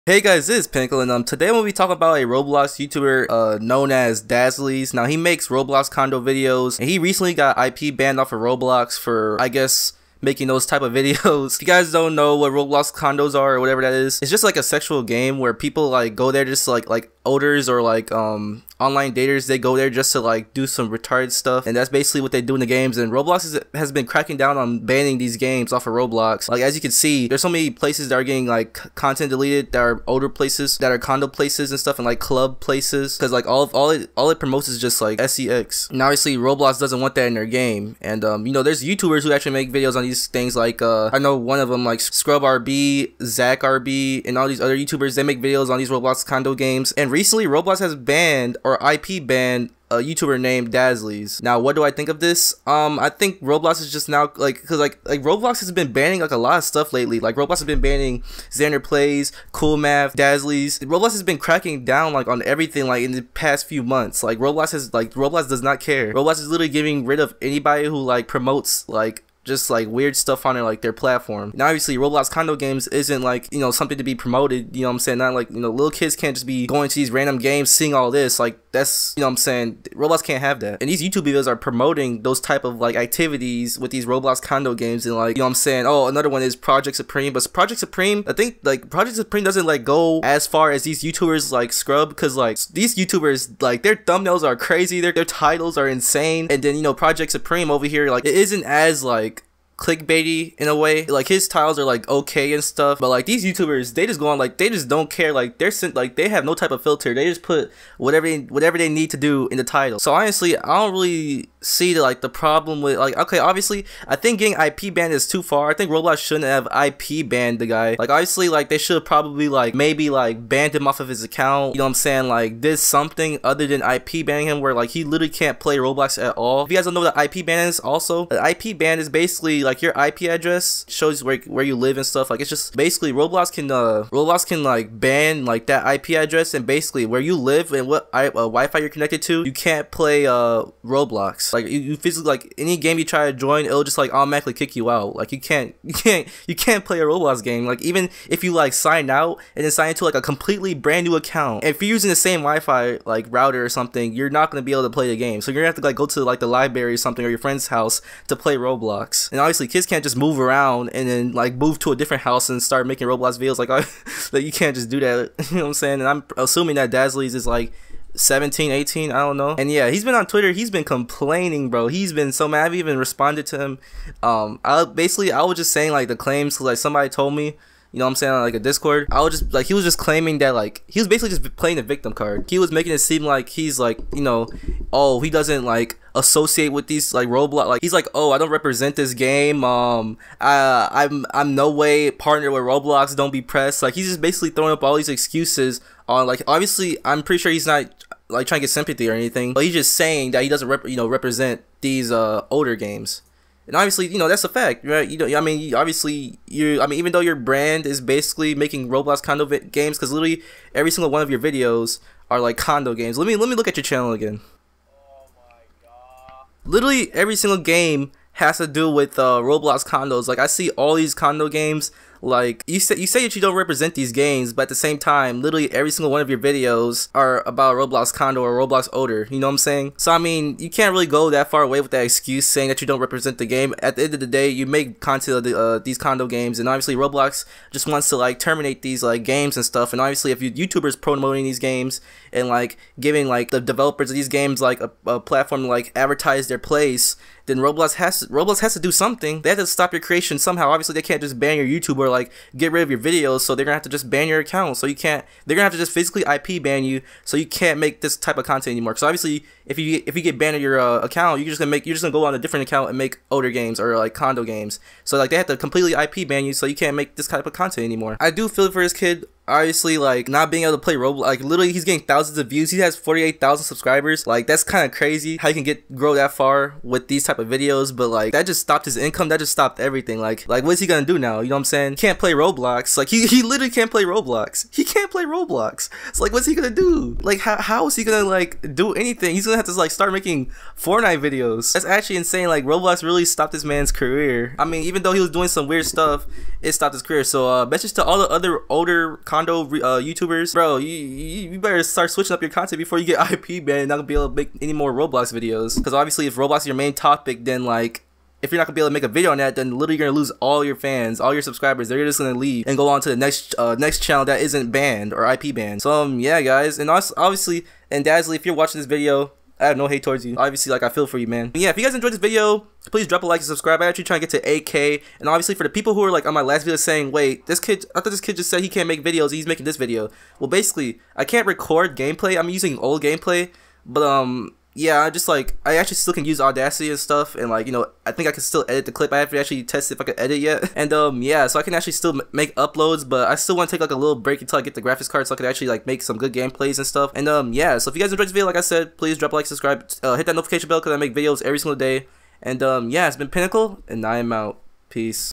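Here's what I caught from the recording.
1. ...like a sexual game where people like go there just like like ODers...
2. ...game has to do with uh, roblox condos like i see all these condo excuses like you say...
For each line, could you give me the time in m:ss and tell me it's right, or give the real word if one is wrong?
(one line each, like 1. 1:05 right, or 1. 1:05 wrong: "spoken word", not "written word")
1. 0:14 right
2. 3:37 wrong: "games", not "excuses".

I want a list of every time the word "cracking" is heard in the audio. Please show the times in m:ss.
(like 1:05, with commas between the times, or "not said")
0:24, 1:01.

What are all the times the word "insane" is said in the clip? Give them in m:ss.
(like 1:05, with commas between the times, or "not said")
1:35, 4:52.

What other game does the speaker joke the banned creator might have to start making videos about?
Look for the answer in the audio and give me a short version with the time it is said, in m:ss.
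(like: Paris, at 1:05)
Fortnite, at 4:50.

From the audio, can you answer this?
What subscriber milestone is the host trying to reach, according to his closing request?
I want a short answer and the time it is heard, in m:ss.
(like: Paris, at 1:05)
8K, at 5:24.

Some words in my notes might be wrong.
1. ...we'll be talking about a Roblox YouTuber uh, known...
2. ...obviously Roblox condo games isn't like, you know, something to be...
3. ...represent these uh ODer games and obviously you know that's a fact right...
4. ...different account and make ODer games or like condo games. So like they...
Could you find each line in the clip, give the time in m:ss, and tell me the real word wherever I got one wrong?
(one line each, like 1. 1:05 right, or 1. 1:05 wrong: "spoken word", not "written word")
1. 0:01 right
2. 1:11 right
3. 3:21 right
4. 4:22 right.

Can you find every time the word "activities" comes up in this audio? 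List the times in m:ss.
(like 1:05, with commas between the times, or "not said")
1:22.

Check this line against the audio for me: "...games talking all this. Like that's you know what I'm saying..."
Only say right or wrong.
wrong.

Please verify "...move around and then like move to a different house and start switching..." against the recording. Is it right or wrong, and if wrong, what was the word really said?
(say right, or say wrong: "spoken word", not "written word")
wrong: "making", not "switching".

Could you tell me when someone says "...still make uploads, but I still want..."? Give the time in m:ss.
5:41.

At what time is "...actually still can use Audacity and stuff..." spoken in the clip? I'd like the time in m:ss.
5:35.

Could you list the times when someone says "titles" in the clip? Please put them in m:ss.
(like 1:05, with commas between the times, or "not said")
1:35, 1:49.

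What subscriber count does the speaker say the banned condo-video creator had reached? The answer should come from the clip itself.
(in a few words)
48,000.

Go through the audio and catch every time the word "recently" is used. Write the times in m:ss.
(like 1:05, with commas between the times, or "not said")
0:06, 0:47.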